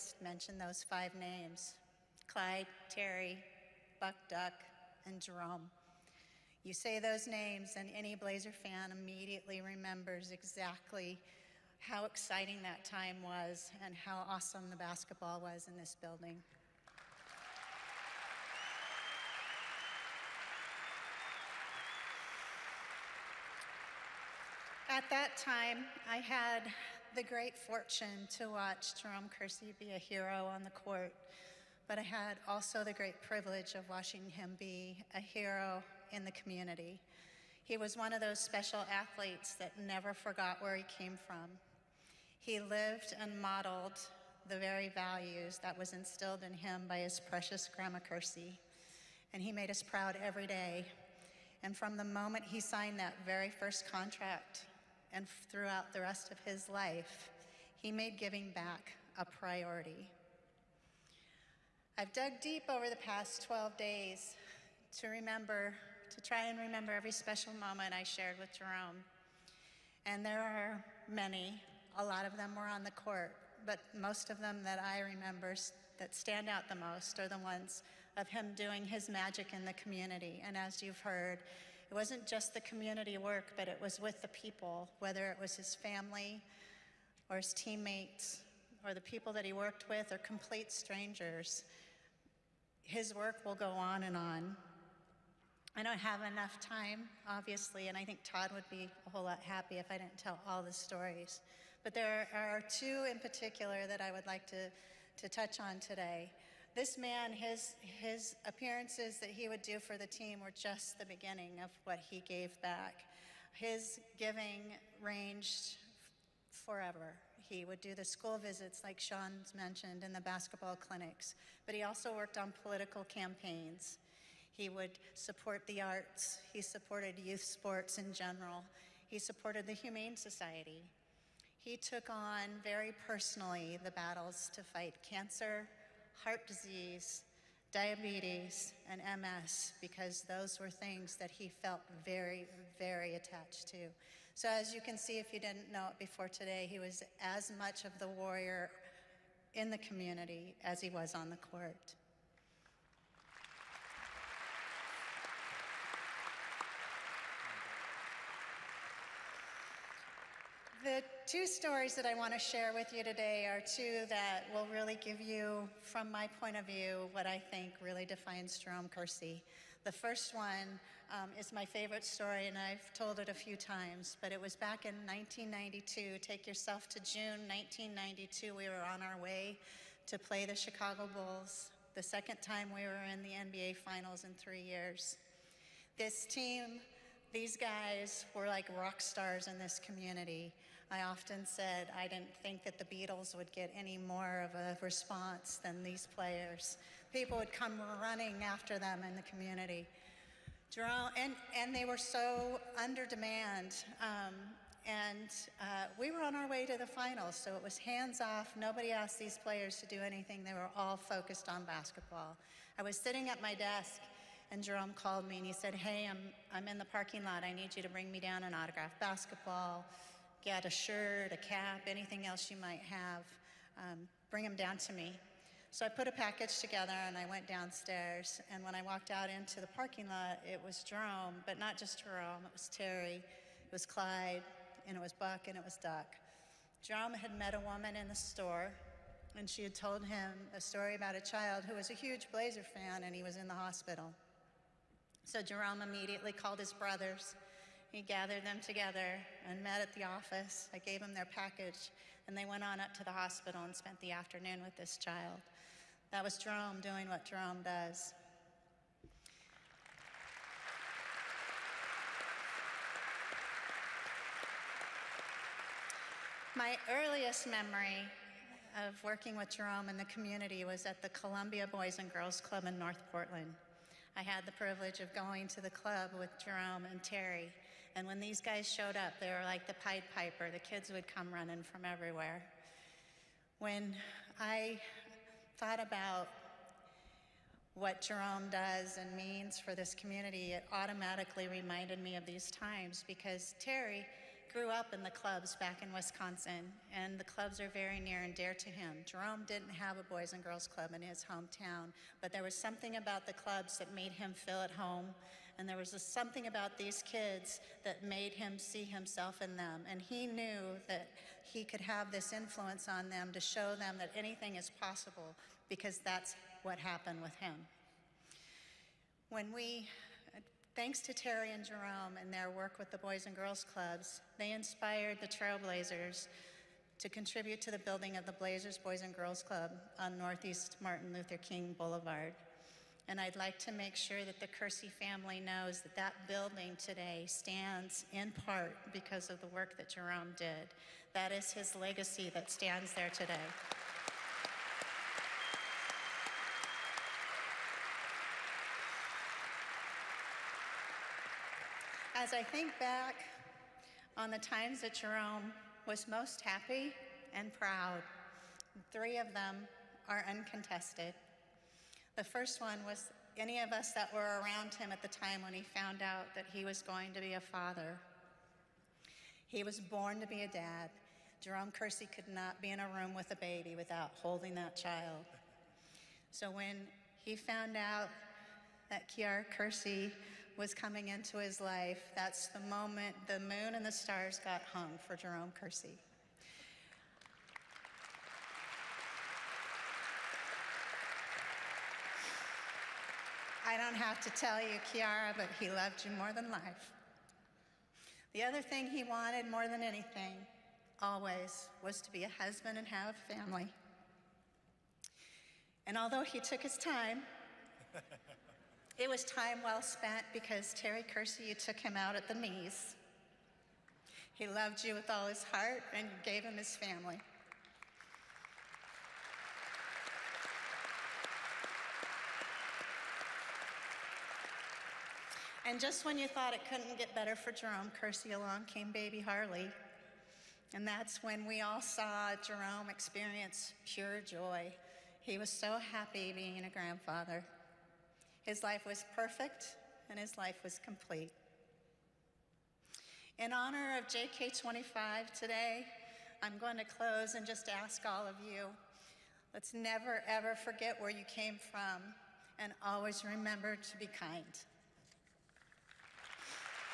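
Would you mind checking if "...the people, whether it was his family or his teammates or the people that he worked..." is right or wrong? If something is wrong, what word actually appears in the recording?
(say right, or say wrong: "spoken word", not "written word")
right.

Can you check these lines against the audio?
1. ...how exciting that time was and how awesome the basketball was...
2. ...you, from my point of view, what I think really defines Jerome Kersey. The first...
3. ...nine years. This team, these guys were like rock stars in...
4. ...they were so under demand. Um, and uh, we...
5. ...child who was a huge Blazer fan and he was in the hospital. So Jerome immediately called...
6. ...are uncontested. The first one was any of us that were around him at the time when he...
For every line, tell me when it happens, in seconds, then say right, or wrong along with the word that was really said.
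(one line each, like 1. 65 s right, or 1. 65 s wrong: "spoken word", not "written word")
1. 11 s right
2. 165 s right
3. 184 s wrong: "three", not "nine"
4. 201 s right
5. 241 s right
6. 360 s right.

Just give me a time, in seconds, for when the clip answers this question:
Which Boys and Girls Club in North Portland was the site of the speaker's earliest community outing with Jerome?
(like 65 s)
271 s.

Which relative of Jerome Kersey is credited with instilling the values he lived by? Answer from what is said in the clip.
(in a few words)
Grandma Kersey.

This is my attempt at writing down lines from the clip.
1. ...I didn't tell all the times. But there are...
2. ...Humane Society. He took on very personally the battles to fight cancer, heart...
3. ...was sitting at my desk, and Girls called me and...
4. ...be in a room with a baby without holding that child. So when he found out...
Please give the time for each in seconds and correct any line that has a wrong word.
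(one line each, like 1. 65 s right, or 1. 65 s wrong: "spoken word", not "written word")
1. 99 s wrong: "stories", not "times"
2. 129 s right
3. 212 s wrong: "Jerome", not "Girls"
4. 372 s right.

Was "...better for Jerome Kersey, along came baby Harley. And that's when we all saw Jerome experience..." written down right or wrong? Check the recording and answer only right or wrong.
right.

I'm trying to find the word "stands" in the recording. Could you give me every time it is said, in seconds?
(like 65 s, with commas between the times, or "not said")
76 s, 337 s, 342 s.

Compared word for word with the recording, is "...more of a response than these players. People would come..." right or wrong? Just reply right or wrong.
right.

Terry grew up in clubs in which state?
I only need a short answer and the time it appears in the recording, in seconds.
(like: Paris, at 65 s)
Wisconsin, at 295 s.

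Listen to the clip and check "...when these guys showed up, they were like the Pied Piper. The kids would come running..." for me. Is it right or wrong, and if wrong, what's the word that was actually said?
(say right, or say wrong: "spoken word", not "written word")
right.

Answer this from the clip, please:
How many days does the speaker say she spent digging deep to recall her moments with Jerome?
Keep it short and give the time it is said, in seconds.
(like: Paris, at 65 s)
12, at 63 s.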